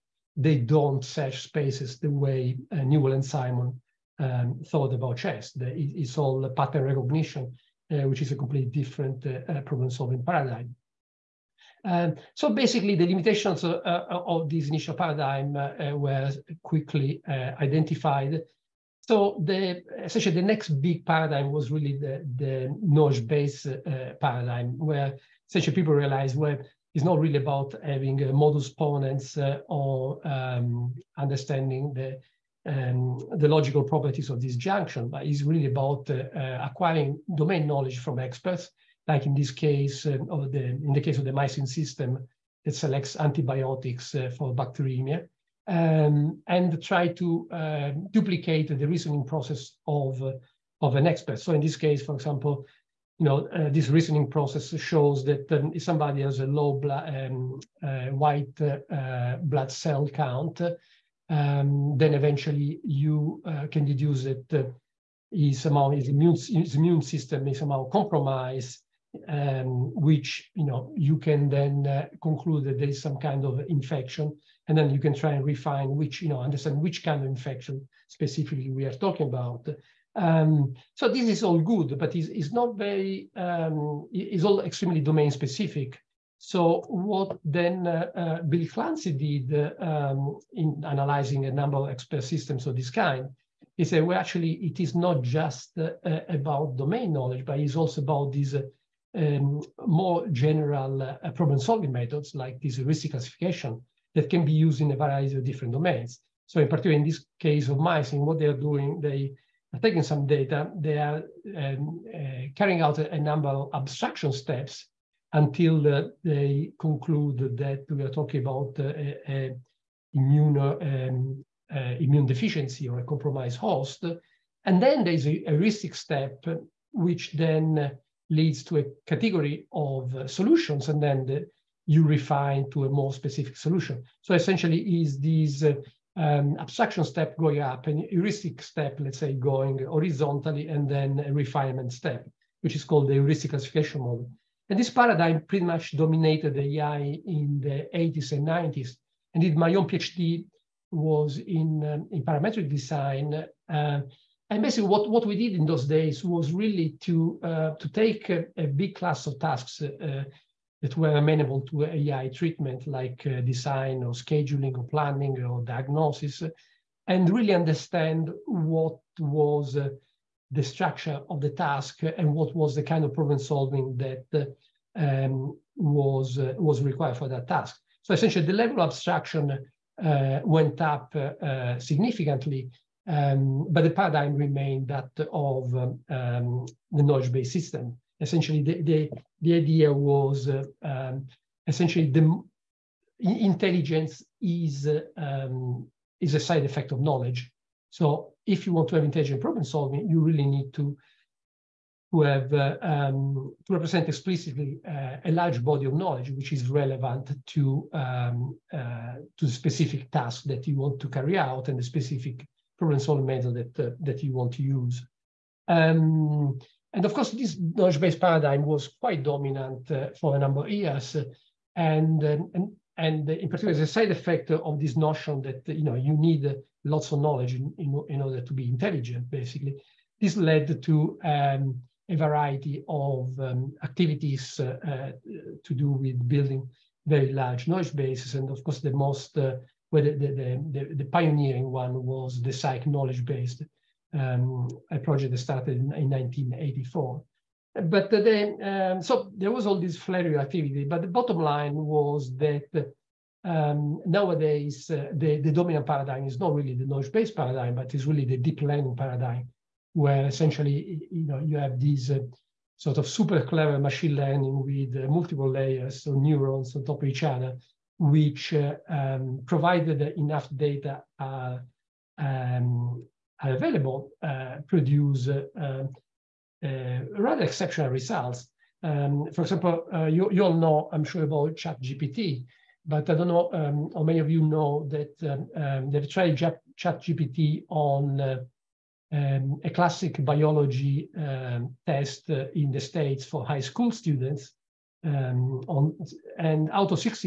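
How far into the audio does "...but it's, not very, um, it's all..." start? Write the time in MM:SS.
01:21.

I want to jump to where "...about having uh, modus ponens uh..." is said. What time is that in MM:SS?
00:27.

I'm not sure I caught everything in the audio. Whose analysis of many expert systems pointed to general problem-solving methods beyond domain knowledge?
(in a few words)
Bill Clancey.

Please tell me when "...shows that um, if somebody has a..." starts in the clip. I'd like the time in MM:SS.
00:54.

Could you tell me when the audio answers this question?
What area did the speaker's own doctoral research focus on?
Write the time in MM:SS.
02:32.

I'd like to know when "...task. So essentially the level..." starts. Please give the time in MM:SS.
02:57.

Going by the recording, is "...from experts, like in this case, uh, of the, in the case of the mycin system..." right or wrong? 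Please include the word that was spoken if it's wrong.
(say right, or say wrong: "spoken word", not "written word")
right.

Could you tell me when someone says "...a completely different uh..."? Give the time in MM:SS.
00:08.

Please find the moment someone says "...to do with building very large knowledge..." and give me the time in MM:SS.
03:55.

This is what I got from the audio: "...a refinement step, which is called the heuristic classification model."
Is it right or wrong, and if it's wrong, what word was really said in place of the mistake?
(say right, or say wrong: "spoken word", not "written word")
right.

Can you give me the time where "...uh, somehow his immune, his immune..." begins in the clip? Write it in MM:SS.
01:04.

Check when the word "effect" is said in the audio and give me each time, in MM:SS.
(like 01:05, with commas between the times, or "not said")
03:16, 03:44.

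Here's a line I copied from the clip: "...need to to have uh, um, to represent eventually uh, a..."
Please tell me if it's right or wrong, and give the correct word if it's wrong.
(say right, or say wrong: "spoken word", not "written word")
wrong: "explicitly", not "eventually".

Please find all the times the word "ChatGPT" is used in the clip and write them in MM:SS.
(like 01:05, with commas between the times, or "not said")
04:41, 04:46.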